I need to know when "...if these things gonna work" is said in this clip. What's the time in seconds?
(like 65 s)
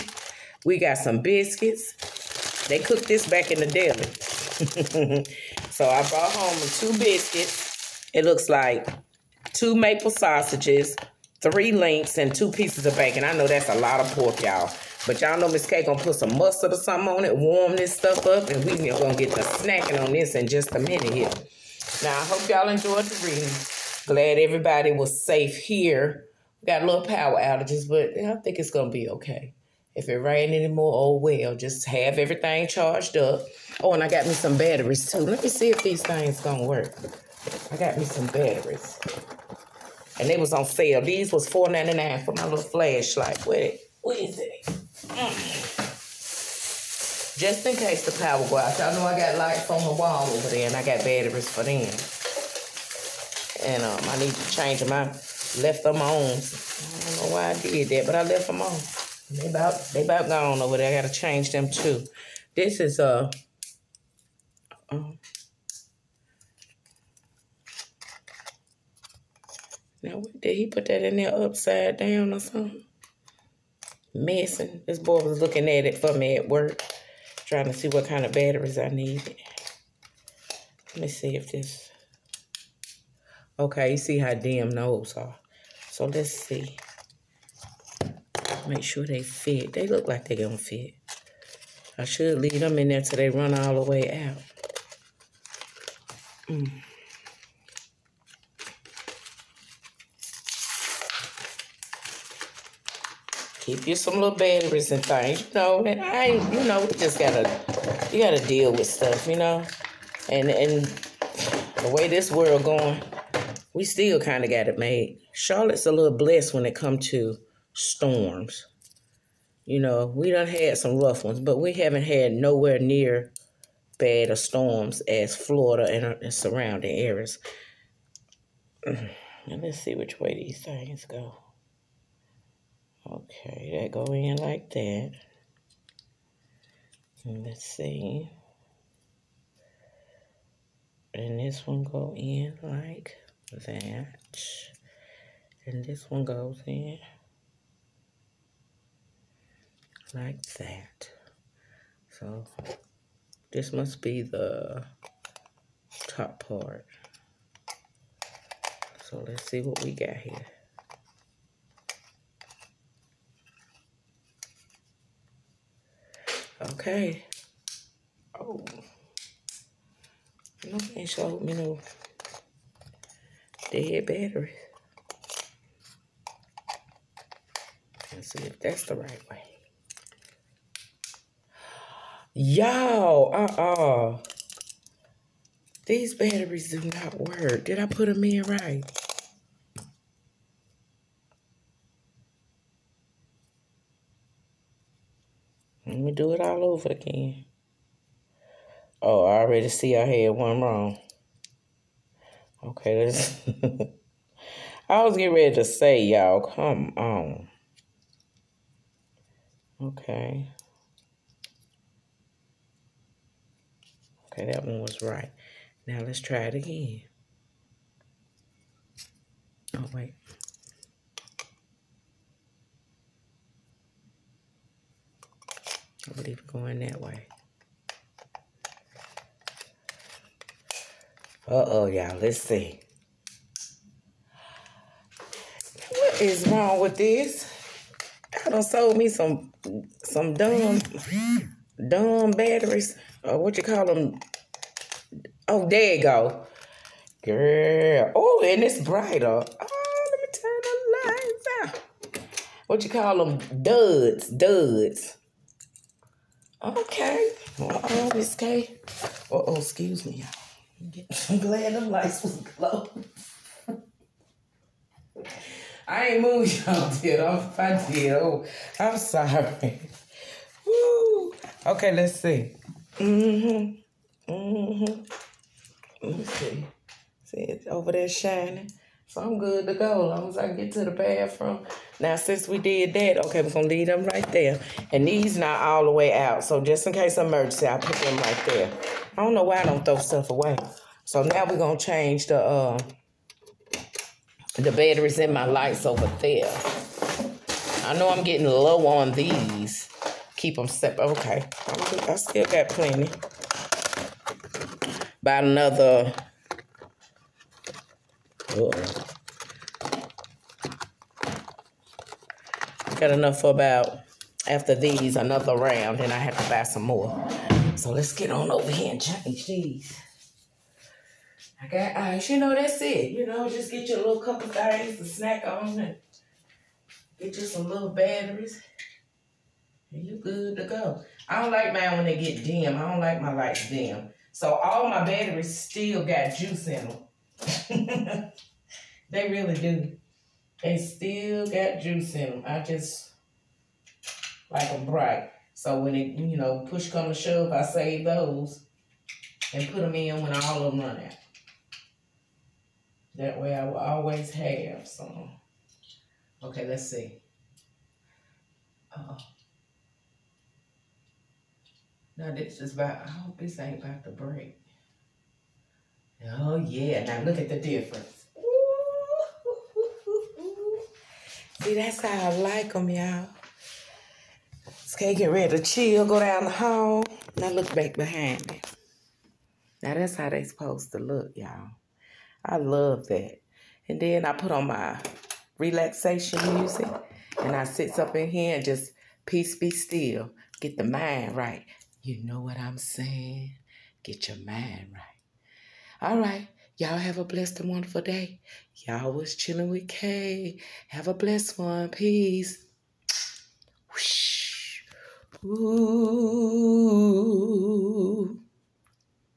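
35 s.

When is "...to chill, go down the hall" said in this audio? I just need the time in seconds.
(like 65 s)
375 s.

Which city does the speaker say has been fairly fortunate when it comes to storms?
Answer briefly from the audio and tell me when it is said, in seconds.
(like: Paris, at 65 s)
Charlotte, at 115 s.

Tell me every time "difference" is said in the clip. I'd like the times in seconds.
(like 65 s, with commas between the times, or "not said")
367 s.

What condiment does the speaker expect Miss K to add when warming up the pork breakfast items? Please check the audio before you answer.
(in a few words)
mustard.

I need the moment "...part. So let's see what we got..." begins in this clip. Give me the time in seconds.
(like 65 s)
156 s.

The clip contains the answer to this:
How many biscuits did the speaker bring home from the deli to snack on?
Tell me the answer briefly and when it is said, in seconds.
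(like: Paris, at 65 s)
2, at 6 s.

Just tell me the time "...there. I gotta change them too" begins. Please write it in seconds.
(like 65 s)
60 s.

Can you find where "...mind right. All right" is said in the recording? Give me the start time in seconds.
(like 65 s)
394 s.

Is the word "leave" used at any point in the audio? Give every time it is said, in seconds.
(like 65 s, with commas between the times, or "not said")
92 s, 283 s.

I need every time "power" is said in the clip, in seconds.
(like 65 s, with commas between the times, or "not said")
27 s, 48 s.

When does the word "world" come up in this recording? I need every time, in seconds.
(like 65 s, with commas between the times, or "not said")
112 s.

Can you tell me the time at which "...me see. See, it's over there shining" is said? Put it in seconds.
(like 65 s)
276 s.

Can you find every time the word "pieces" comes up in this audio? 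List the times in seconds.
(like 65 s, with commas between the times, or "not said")
12 s.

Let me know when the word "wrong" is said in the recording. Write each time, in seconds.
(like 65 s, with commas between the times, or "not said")
200 s, 236 s.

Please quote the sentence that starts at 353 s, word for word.
That way I will always have some.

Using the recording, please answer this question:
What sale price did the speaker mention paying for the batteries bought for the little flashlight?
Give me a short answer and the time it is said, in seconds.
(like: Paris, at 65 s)
$4.99, at 41 s.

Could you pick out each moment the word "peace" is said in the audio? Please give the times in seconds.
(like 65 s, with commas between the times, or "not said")
389 s, 401 s.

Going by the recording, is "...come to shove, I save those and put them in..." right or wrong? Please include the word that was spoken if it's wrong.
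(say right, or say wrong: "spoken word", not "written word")
right.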